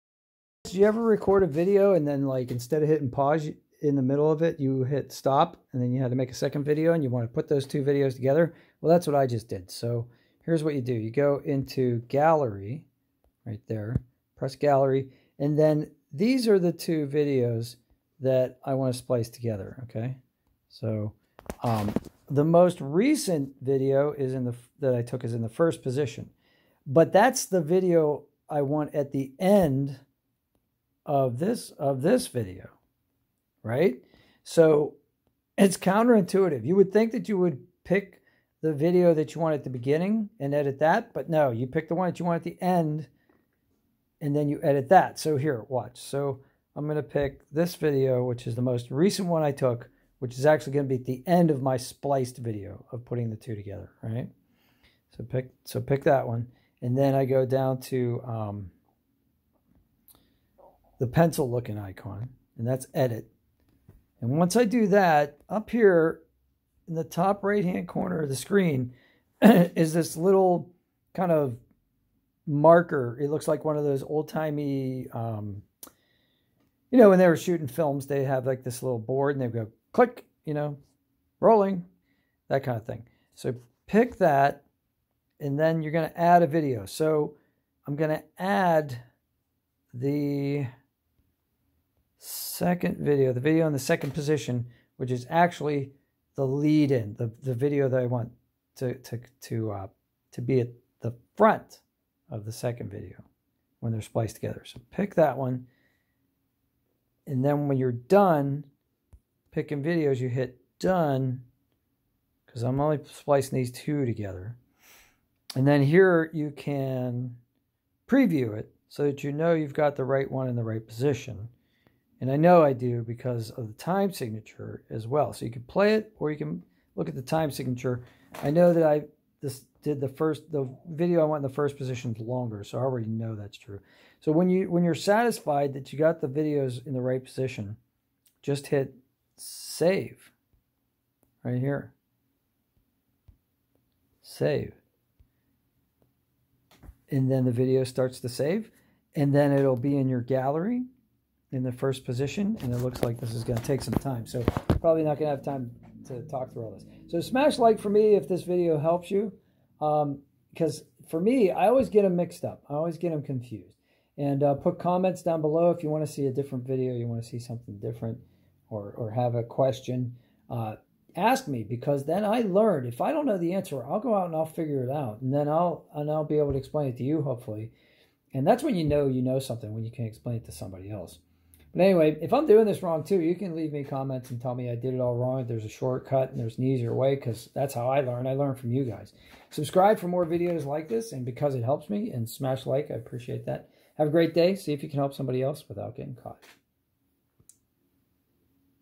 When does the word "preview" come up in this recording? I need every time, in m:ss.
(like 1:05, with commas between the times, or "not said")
1:58.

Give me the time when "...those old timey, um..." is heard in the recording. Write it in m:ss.
1:13.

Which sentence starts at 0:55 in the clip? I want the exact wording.
So pick so pick that one, and then I go down to um, the pencil looking icon, and that's edit.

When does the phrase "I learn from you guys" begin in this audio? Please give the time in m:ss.
3:08.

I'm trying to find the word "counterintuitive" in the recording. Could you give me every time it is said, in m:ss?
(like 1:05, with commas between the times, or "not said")
0:35.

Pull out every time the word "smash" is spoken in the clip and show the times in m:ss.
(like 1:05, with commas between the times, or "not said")
2:37, 3:12.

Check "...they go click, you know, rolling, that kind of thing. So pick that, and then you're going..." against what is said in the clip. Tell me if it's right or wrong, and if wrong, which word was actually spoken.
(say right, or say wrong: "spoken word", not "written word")
right.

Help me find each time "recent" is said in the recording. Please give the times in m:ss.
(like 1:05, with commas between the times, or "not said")
0:22, 0:48.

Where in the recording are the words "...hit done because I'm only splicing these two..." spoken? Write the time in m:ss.
1:50.